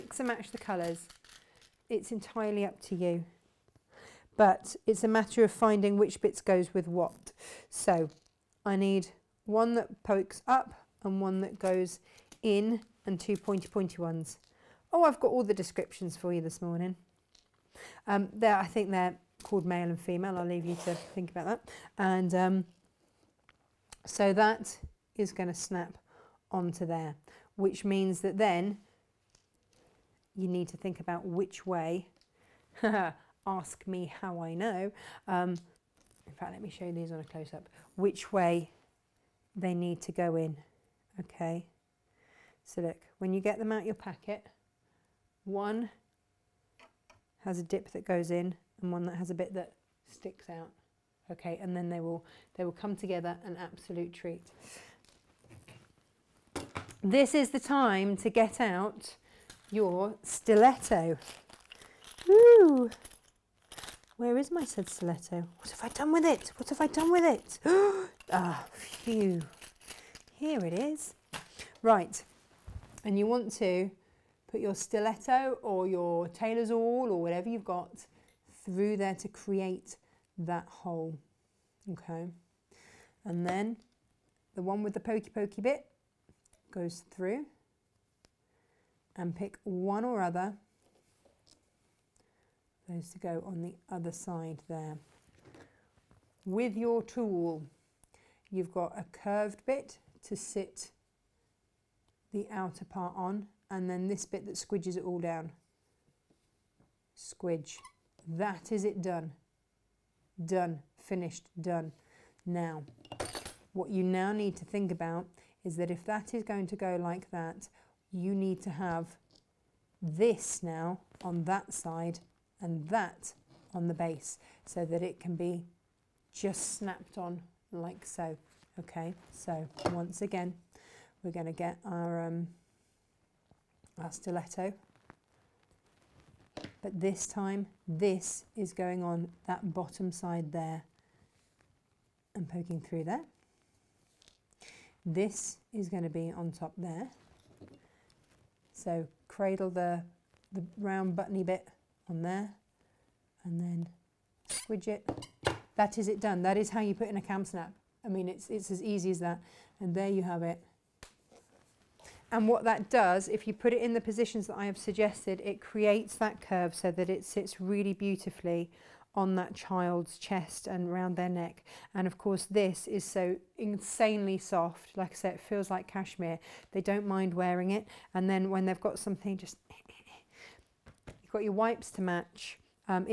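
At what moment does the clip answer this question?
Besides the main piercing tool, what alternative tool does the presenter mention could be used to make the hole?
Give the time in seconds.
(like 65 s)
76 s.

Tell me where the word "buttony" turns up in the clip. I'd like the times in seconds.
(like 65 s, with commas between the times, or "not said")
151 s.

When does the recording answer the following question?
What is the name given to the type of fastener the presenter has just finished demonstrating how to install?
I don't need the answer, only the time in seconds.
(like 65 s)
157 s.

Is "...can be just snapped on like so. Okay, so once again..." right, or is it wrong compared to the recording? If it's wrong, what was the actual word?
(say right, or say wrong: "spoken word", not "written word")
right.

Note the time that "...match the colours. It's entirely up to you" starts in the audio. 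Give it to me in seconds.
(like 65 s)
0 s.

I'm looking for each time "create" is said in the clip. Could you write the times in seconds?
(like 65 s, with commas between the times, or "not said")
79 s, 165 s.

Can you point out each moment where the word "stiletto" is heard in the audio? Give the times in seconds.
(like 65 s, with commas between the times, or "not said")
60 s, 64 s, 74 s, 134 s.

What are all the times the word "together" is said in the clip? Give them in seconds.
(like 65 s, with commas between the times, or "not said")
52 s.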